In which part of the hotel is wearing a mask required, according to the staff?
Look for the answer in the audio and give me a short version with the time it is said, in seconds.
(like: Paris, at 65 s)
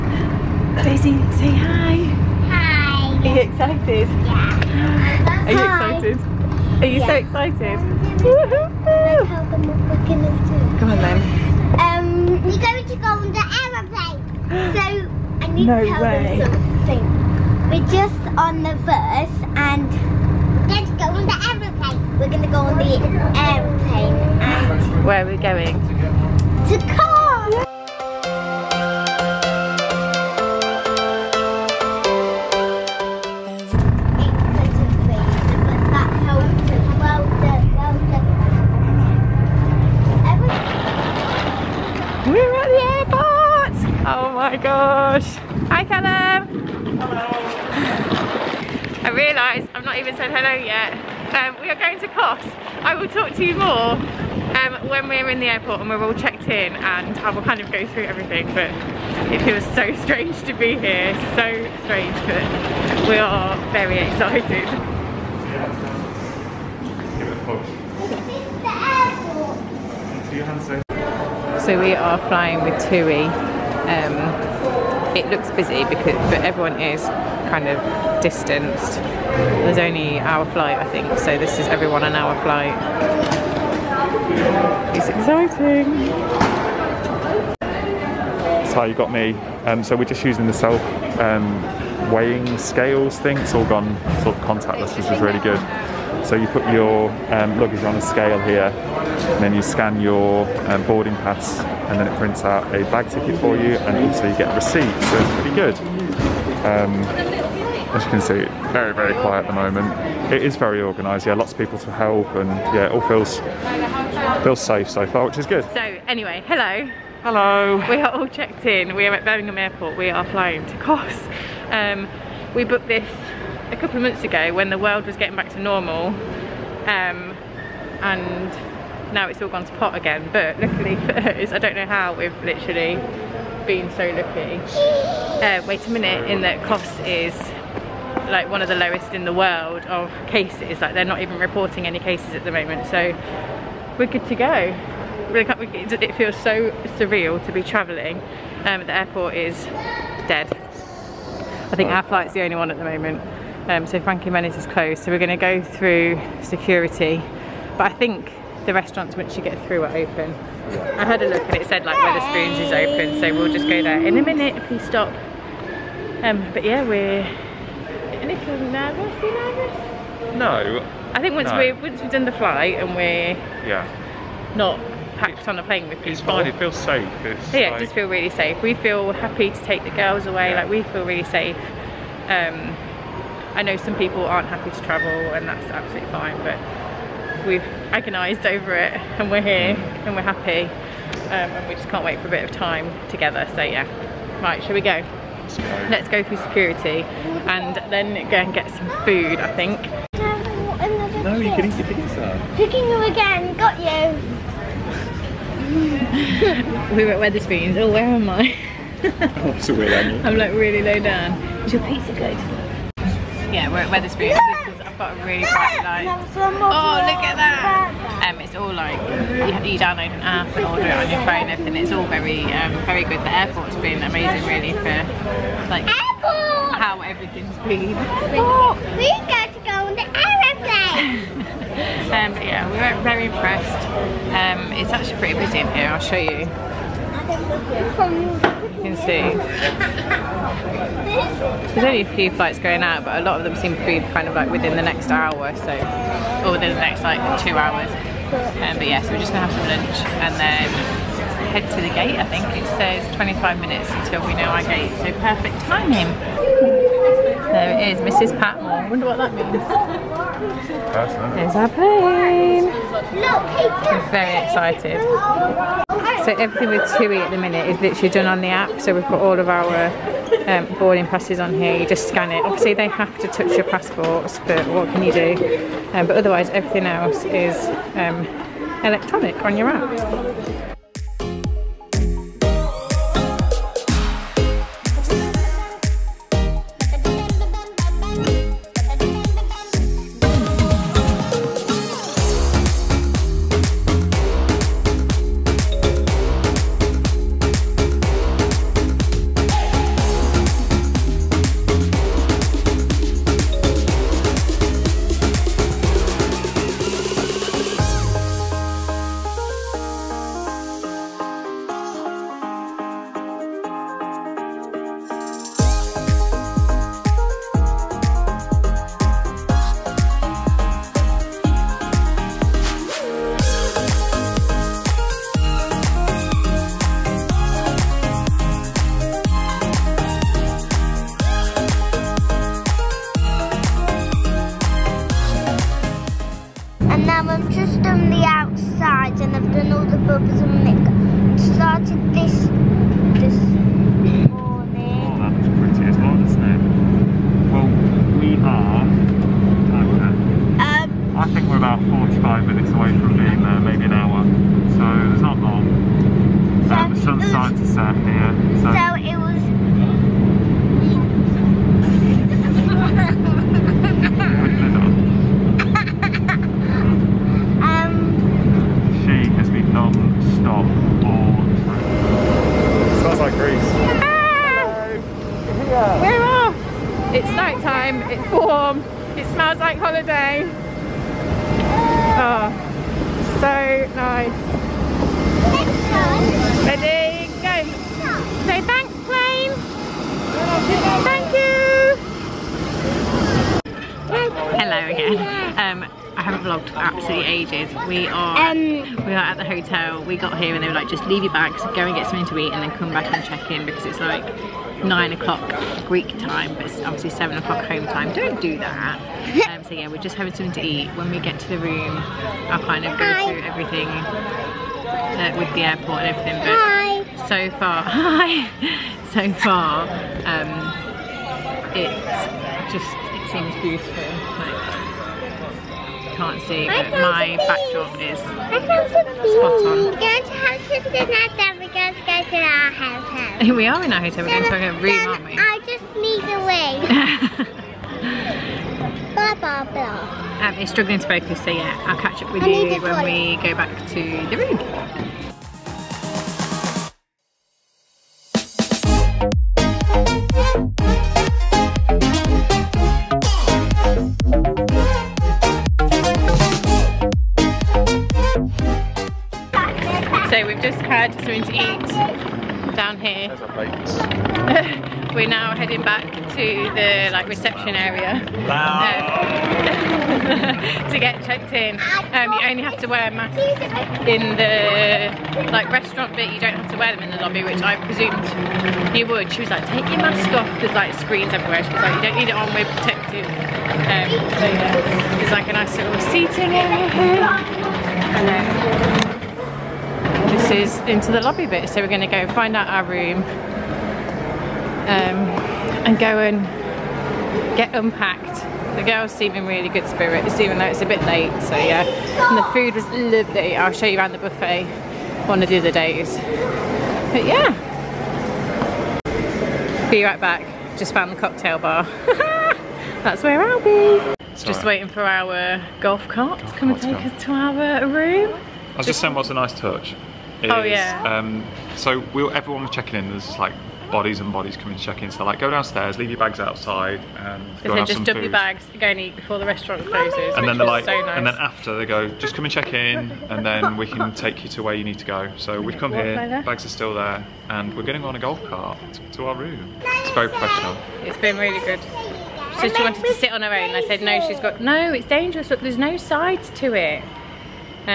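the restaurant, at 475 s.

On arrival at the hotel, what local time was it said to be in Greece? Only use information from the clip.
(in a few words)
9 o'clock.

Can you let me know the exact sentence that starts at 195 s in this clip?
Let's go, through security and then go and get some food, I think.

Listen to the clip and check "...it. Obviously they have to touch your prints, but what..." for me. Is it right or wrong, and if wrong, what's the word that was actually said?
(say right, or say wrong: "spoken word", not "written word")
wrong: "passports", not "prints".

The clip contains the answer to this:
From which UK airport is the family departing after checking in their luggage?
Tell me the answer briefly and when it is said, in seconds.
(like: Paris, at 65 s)
Birmingham Airport, at 119 s.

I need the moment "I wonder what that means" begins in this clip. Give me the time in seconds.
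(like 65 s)
258 s.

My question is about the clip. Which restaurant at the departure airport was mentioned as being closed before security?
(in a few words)
Frankie & Benny's.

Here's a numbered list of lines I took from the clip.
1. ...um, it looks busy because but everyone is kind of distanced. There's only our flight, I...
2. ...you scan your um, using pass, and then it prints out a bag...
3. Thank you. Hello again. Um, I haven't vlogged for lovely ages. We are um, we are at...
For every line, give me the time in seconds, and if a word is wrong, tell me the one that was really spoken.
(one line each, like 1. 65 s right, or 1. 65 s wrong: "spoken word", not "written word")
1. 73 s right
2. 99 s wrong: "boarding", not "using"
3. 391 s wrong: "absolutely", not "lovely".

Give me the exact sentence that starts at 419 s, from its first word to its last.
so far, um, it's just it seems beautiful.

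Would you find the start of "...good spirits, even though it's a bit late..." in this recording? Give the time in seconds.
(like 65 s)
499 s.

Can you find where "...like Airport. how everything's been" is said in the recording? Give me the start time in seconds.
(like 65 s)
225 s.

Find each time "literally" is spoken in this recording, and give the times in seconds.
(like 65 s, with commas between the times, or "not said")
132 s, 267 s.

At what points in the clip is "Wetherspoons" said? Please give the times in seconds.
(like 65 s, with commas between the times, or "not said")
207 s, 213 s.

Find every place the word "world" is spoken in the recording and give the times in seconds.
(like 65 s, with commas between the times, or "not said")
124 s, 139 s.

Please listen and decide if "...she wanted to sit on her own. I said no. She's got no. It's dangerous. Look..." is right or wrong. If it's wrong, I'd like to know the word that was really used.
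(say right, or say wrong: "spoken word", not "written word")
right.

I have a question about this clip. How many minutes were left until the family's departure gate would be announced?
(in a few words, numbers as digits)
25.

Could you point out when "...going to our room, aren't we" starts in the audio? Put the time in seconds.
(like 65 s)
434 s.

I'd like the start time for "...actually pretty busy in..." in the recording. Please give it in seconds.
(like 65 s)
234 s.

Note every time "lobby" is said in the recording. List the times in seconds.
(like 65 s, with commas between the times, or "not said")
477 s, 491 s.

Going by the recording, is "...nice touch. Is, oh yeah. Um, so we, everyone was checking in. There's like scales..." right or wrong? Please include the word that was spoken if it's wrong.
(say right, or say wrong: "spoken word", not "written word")
wrong: "bodies", not "scales".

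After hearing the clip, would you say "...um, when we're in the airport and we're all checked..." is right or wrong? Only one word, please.
right.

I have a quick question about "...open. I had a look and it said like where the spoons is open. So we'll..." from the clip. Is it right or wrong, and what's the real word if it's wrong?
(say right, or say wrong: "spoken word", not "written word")
right.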